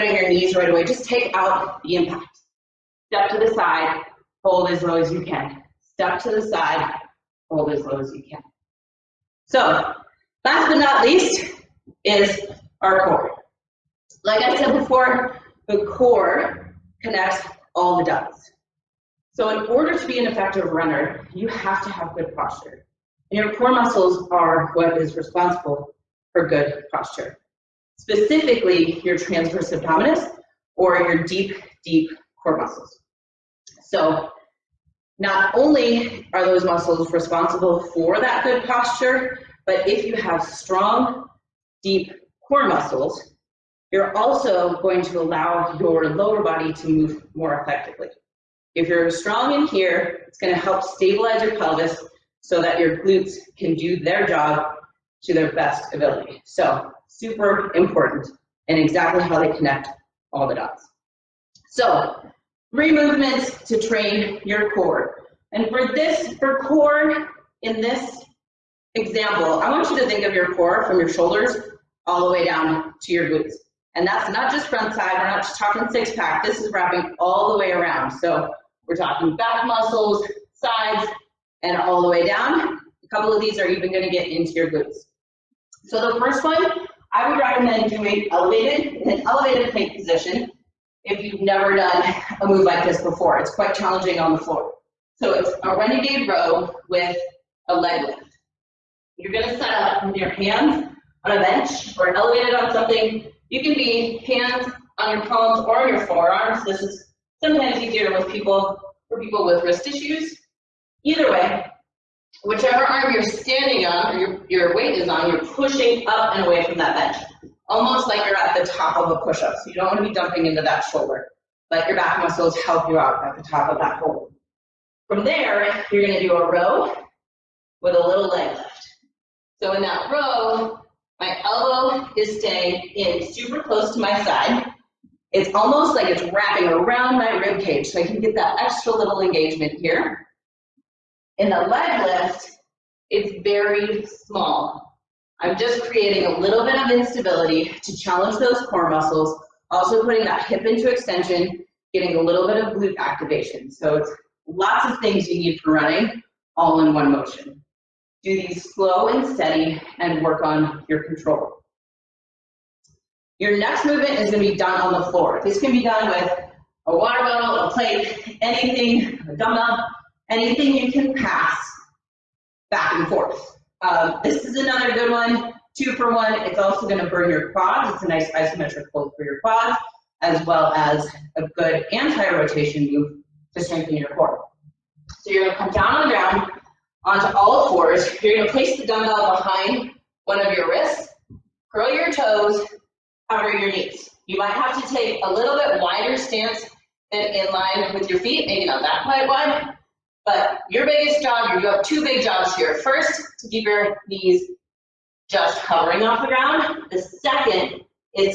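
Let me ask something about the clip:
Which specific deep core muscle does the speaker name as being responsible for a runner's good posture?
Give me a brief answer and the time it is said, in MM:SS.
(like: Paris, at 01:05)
Transverse abdominis, at 00:29.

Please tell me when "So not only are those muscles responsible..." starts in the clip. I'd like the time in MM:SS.
00:33.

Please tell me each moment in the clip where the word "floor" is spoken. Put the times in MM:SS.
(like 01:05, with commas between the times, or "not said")
01:34, 02:45.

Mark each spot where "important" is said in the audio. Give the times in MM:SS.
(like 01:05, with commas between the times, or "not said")
00:57.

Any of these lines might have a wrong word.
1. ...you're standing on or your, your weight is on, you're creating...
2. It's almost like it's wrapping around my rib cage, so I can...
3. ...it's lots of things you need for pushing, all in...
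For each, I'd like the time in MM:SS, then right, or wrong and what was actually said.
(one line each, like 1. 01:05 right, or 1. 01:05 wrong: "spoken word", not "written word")
1. 01:53 wrong: "pushing", not "creating"
2. 02:15 right
3. 02:33 wrong: "running", not "pushing".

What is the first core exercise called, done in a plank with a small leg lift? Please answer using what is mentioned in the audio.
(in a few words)
Renegade row.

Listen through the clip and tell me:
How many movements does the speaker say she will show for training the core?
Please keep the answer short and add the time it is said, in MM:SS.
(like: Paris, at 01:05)
3, at 01:02.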